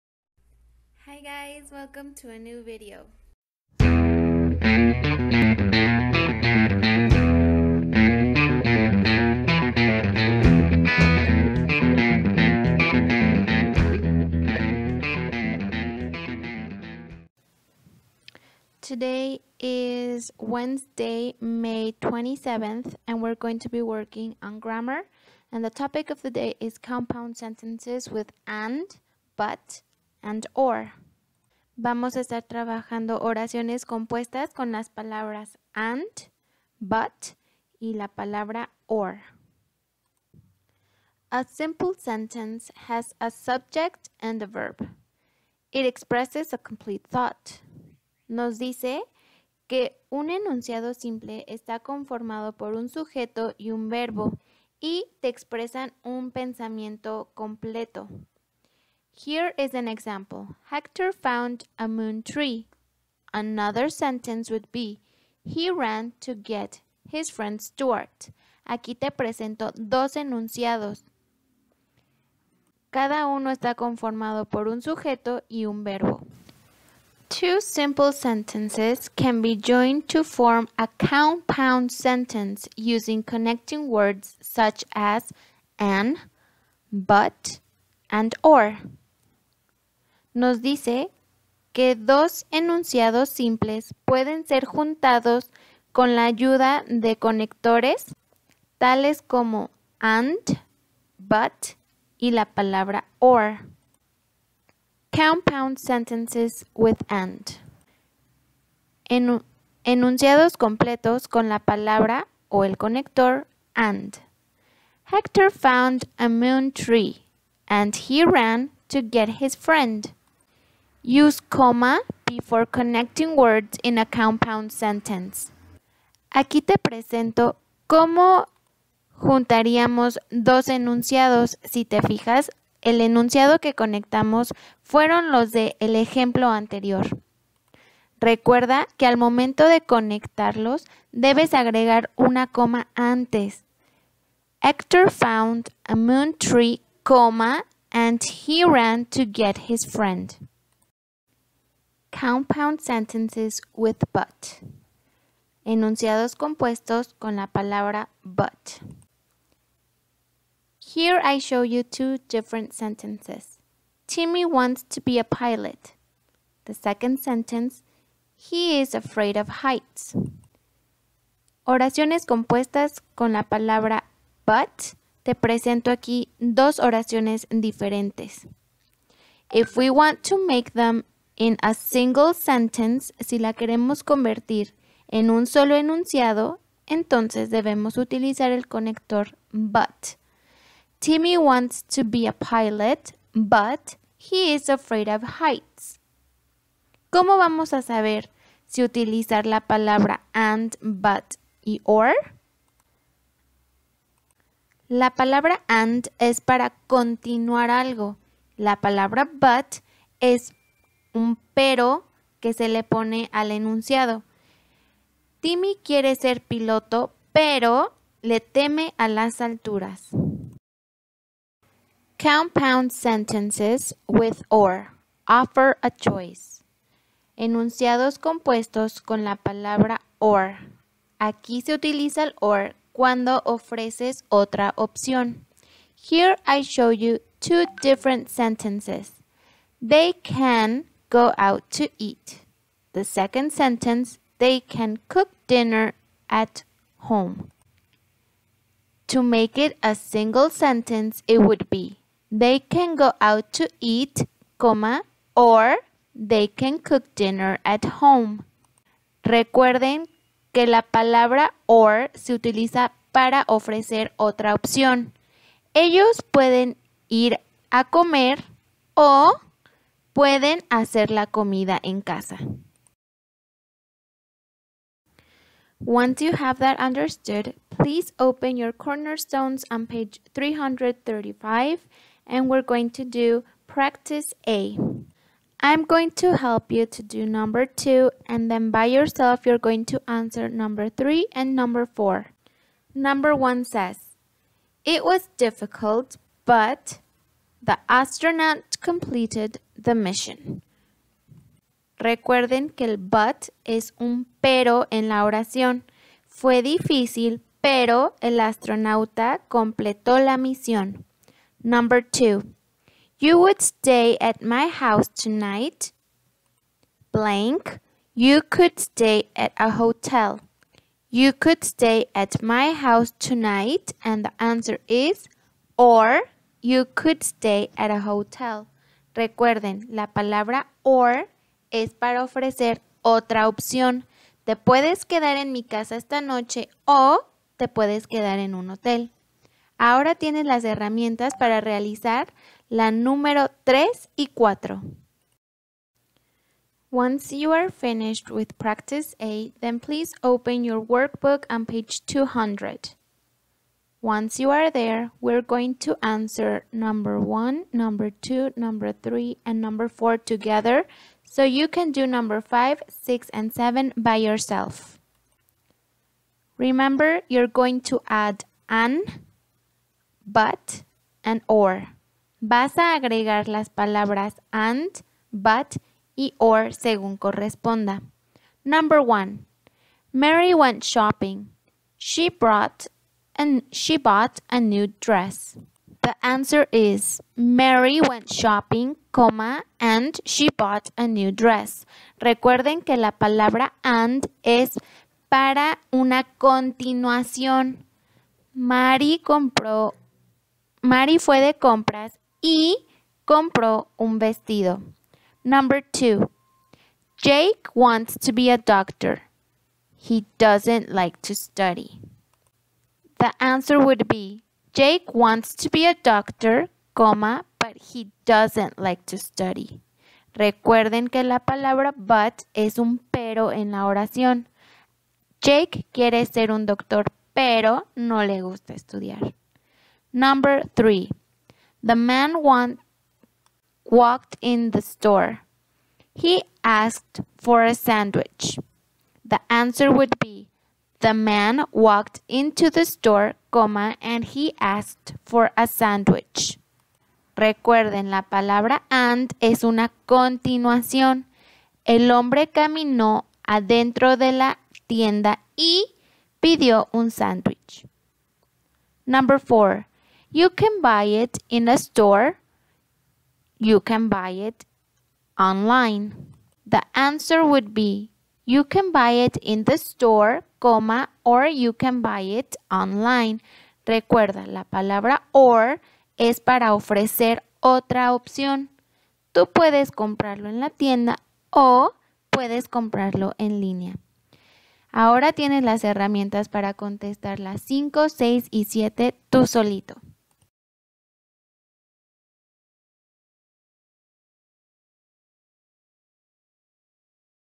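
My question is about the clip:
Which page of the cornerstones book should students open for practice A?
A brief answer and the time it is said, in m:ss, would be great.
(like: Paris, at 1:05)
335, at 4:40.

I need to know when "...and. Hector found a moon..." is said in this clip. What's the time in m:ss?
1:53.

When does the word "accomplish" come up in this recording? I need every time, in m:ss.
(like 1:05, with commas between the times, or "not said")
not said.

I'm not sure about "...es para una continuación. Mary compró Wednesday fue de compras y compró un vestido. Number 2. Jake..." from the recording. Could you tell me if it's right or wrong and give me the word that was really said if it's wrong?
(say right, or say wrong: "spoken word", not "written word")
wrong: "Mary", not "Wednesday".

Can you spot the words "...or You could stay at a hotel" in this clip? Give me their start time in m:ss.
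5:25.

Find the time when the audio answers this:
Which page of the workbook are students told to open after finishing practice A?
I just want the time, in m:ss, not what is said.
5:52.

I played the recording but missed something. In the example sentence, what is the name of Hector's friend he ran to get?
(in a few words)
Stuart.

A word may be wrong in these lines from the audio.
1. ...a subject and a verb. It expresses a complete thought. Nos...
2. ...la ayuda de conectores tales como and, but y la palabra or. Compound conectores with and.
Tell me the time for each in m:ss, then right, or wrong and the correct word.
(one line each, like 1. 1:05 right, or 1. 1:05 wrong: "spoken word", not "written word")
1. 0:43 right
2. 1:36 wrong: "sentences", not "conectores".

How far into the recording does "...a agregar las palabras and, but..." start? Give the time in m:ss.
6:12.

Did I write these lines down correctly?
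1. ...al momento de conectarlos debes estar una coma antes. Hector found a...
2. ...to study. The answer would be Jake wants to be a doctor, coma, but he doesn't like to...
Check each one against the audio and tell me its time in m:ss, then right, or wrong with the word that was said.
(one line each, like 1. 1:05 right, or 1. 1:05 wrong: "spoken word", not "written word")
1. 2:19 wrong: "agregar", not "estar"
2. 6:51 right.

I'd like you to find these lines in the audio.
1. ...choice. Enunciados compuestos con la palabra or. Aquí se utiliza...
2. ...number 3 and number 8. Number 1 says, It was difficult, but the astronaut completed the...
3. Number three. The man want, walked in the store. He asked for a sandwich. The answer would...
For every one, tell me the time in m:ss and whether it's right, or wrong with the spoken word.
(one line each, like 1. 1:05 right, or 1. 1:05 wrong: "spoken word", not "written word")
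1. 3:45 right
2. 4:50 wrong: "4", not "8"
3. 7:10 right.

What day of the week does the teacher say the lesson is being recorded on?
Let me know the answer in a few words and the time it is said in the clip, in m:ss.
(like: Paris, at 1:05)
Wednesday, at 0:20.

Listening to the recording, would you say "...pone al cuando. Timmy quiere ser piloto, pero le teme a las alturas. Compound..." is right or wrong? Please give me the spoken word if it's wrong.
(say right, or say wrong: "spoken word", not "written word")
wrong: "enunciado", not "cuando".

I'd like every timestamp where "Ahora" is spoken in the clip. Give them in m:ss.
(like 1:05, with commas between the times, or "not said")
5:39, 8:04.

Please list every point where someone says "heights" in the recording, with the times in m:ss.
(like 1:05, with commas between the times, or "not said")
2:49, 3:15.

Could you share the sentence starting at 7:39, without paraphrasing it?
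Number four, you can buy it in a store.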